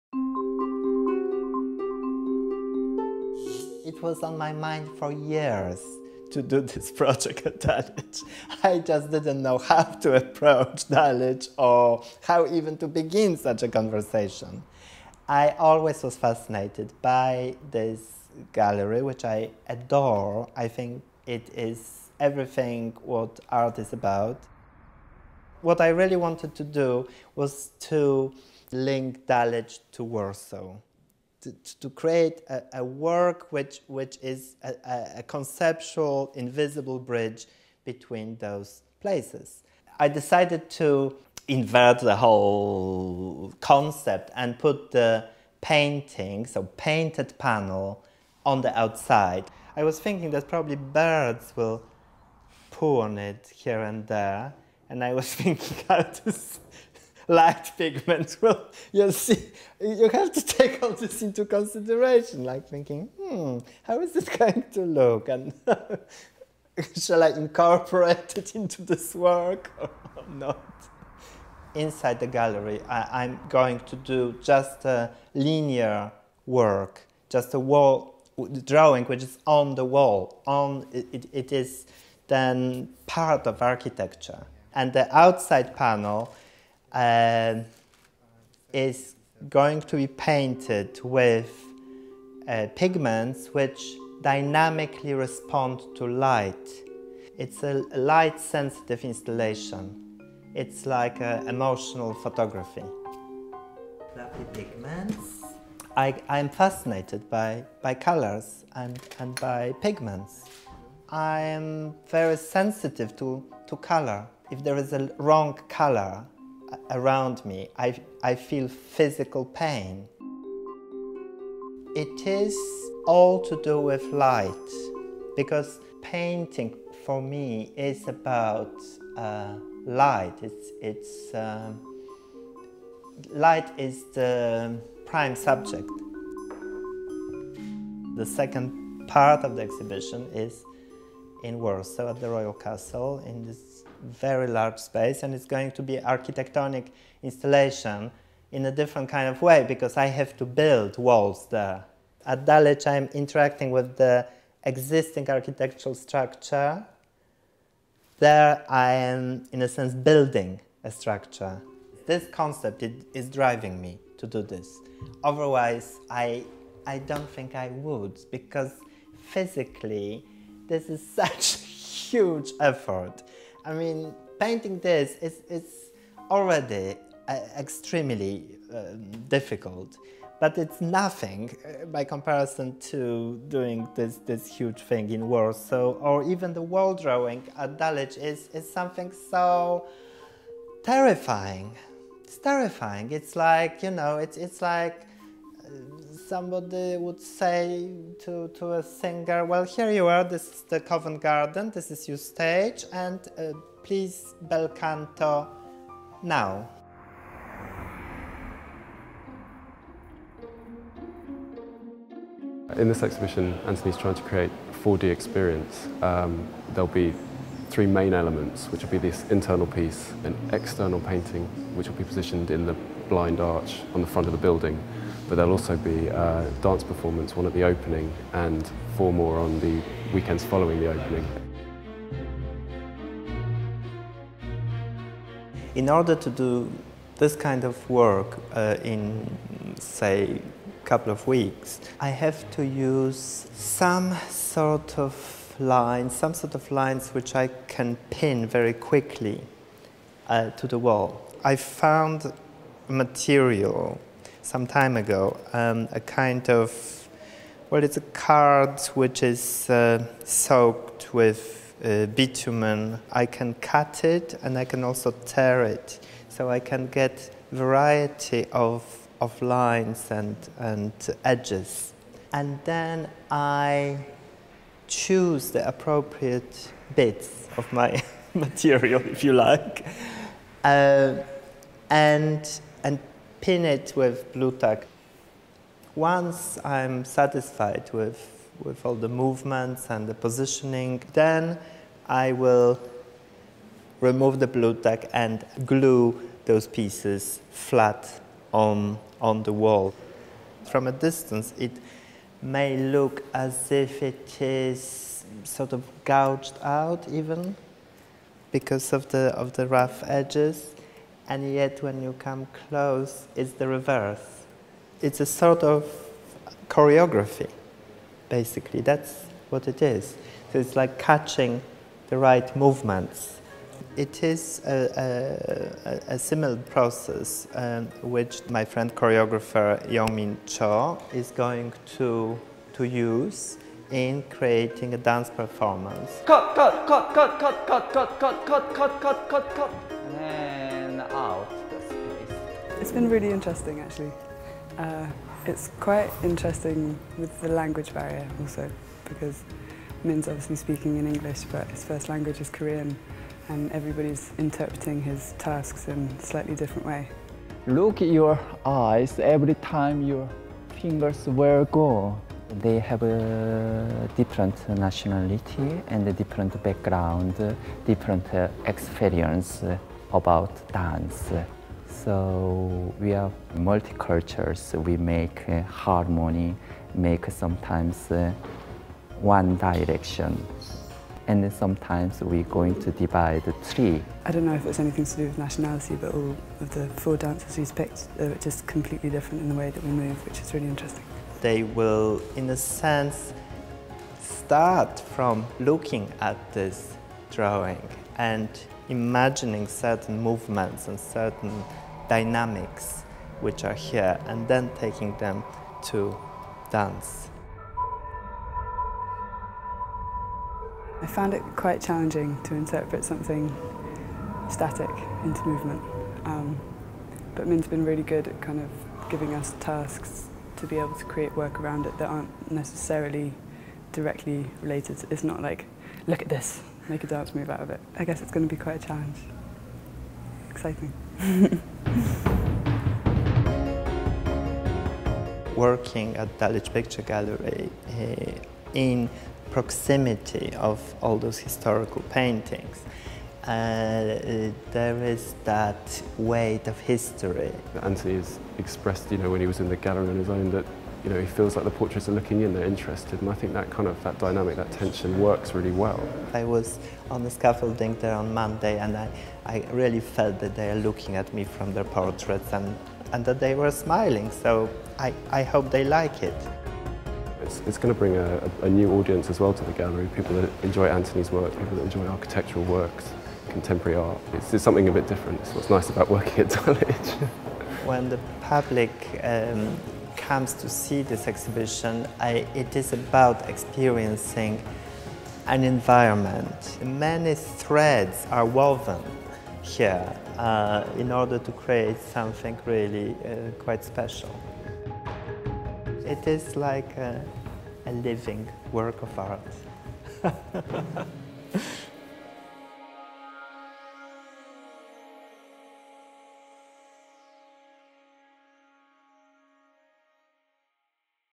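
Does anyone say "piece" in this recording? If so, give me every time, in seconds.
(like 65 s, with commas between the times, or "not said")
219 s, 296 s.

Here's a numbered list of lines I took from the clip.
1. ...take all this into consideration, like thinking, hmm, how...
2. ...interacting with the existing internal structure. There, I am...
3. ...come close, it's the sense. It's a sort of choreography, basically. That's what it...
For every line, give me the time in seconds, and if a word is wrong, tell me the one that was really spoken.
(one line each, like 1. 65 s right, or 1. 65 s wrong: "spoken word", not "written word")
1. 60 s right
2. 153 s wrong: "architectural", not "internal"
3. 312 s wrong: "reverse", not "sense".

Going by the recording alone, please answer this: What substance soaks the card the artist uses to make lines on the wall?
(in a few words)
Bitumen.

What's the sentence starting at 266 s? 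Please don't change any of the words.
So I can get variety of, of lines and, and edges.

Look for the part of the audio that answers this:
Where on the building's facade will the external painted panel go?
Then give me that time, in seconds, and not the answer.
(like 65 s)
223 s.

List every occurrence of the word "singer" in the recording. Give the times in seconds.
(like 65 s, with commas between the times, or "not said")
198 s.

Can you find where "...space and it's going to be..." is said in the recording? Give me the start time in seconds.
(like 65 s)
144 s.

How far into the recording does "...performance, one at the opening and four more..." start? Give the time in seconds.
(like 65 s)
226 s.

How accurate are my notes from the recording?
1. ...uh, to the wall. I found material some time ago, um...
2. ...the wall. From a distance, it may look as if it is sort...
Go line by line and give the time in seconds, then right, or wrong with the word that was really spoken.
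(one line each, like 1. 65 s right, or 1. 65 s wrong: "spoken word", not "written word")
1. 250 s right
2. 299 s right.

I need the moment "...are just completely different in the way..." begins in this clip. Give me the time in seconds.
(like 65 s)
388 s.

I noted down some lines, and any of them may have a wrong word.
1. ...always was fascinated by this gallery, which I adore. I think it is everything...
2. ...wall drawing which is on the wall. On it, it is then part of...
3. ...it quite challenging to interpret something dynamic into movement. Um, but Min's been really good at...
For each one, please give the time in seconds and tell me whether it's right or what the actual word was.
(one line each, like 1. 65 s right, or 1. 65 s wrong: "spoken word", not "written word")
1. 15 s right
2. 77 s right
3. 411 s wrong: "static", not "dynamic".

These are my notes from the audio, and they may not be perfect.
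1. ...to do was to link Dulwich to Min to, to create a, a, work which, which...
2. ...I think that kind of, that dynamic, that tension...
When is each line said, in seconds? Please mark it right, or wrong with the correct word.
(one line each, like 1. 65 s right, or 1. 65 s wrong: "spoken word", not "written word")
1. 26 s wrong: "Warsaw", not "Min"
2. 453 s right.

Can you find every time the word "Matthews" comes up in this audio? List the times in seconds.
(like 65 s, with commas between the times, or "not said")
not said.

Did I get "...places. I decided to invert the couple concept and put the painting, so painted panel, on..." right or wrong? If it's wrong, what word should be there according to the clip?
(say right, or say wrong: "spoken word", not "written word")
wrong: "whole", not "couple".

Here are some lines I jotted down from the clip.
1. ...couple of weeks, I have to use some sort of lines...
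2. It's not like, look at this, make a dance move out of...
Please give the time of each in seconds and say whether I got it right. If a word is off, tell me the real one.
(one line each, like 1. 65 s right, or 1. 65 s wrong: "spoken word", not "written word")
1. 240 s right
2. 425 s right.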